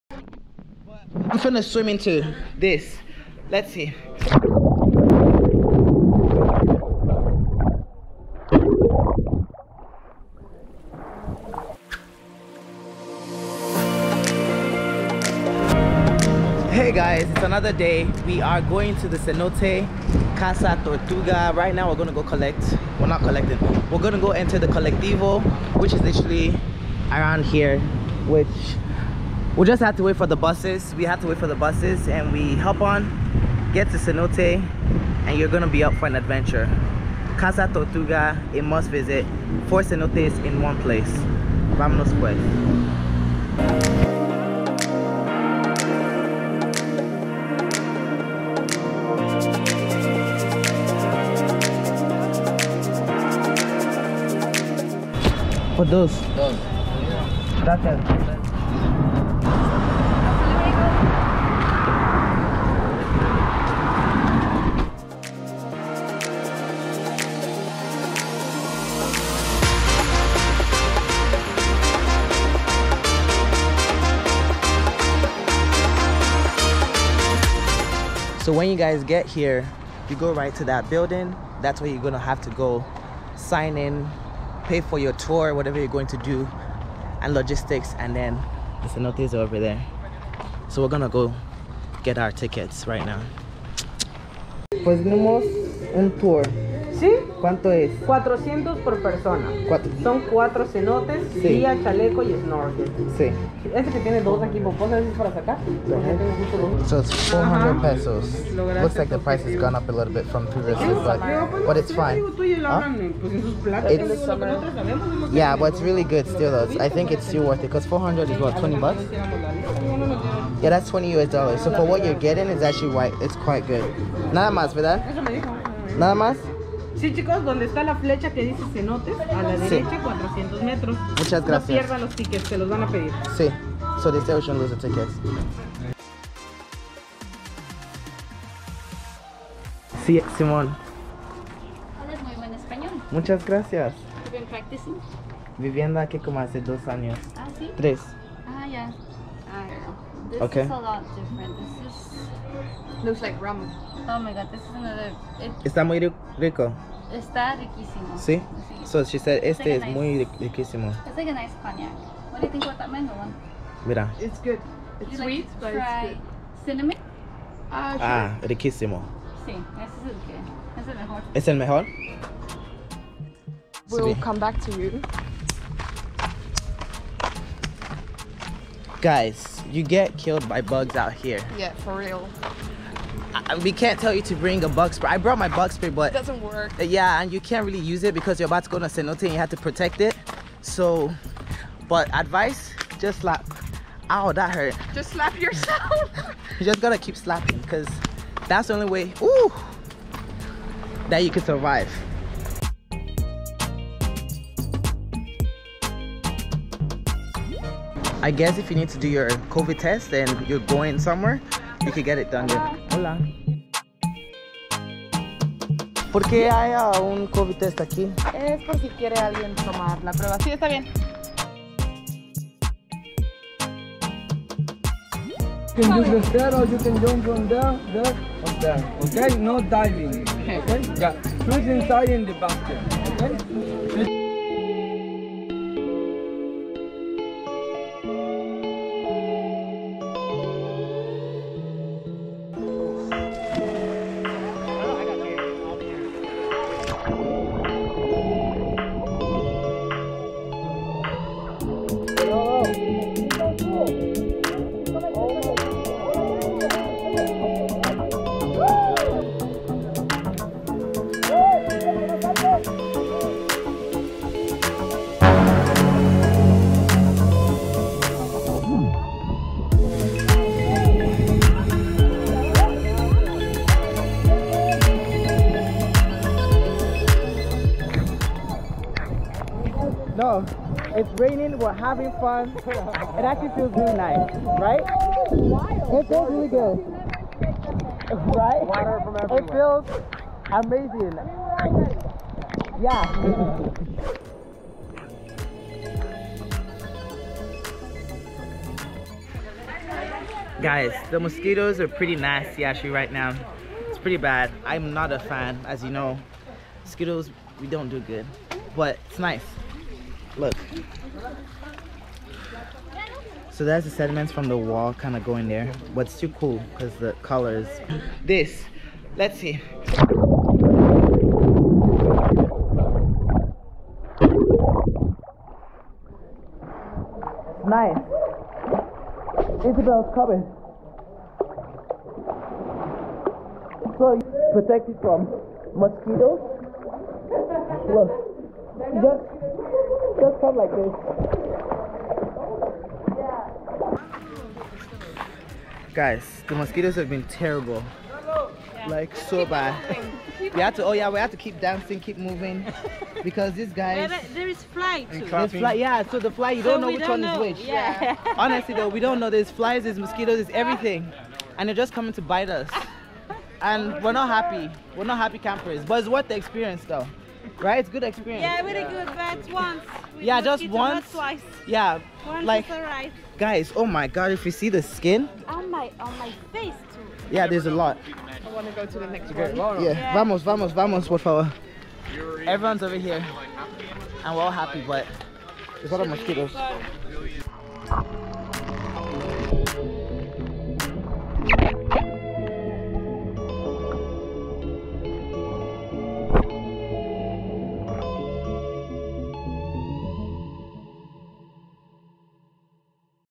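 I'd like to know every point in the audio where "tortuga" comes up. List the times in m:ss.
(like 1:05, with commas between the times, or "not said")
0:20, 0:37.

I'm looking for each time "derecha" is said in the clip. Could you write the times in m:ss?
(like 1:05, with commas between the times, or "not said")
2:09.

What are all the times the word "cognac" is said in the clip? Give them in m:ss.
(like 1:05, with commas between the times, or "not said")
2:41.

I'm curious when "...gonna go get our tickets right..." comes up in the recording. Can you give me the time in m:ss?
1:30.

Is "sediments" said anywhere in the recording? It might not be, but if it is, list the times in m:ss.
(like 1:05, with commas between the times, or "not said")
5:13.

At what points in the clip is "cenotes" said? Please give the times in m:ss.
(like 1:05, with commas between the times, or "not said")
0:19, 0:33, 0:39, 1:28, 1:40, 2:08, 3:08.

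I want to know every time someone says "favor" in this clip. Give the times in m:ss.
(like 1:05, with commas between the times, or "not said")
6:21.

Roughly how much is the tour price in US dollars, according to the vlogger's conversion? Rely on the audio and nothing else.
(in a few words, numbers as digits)
20 US dollars.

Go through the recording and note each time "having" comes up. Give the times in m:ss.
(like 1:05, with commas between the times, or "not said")
4:41.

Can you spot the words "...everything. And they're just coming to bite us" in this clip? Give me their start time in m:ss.
6:00.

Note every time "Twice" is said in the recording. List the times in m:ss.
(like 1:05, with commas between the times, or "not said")
6:11.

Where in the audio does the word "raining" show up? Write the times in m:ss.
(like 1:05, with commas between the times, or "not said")
4:41.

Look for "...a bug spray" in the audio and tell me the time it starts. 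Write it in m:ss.
3:04.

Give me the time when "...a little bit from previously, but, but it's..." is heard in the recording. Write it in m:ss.
1:49.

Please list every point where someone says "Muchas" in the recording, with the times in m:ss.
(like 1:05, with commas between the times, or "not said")
2:11, 2:23.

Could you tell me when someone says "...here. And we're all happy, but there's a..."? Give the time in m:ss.
6:22.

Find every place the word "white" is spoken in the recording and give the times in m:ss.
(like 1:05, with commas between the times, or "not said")
2:02.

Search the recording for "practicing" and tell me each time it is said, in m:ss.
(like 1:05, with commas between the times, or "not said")
2:24.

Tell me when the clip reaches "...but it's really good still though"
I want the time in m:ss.
1:55.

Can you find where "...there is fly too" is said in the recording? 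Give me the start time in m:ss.
5:54.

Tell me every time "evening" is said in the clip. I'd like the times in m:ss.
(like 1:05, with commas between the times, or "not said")
not said.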